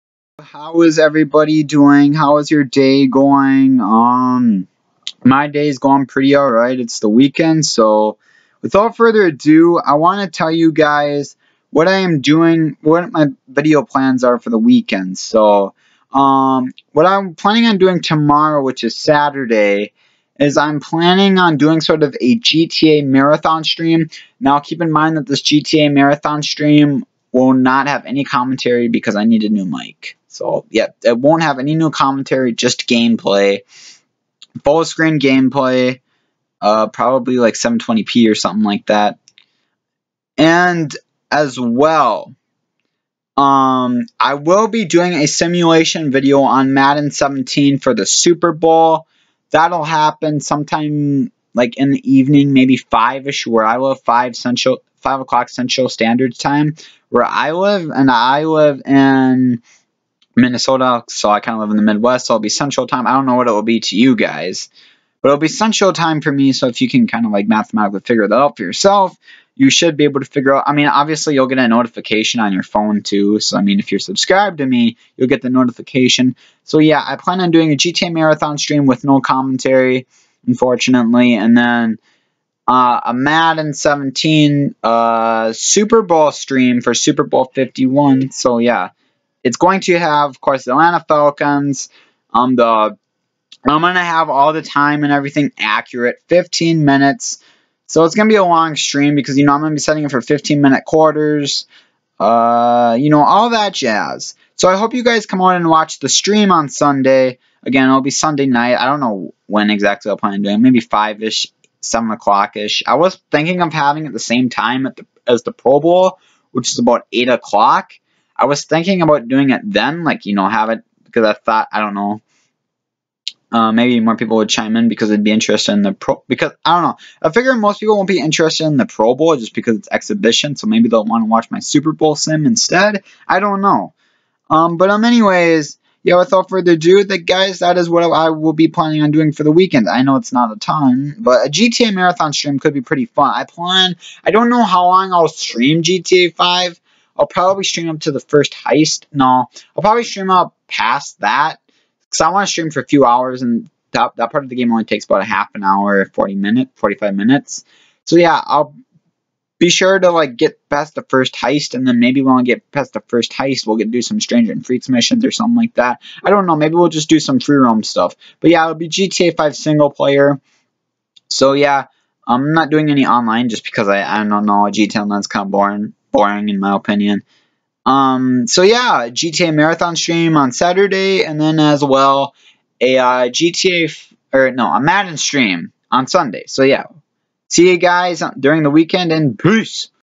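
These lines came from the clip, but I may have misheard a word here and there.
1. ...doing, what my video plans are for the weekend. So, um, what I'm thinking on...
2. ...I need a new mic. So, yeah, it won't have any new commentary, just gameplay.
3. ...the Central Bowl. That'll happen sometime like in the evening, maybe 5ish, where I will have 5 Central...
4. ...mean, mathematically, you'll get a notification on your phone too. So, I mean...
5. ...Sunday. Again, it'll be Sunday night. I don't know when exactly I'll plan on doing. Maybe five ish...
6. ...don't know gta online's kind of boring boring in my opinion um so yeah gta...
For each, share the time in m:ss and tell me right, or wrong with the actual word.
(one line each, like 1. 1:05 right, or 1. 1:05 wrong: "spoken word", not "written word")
1. 0:12 wrong: "planning", not "thinking"
2. 0:29 right
3. 0:47 wrong: "Super", not "Central"
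4. 1:10 wrong: "obviously", not "mathematically"
5. 1:46 right
6. 2:54 right.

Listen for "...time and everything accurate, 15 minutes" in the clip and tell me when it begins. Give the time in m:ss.
1:34.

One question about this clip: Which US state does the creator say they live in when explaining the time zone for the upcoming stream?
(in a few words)
Minnesota.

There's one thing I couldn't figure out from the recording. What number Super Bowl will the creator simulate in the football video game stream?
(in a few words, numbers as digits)
51.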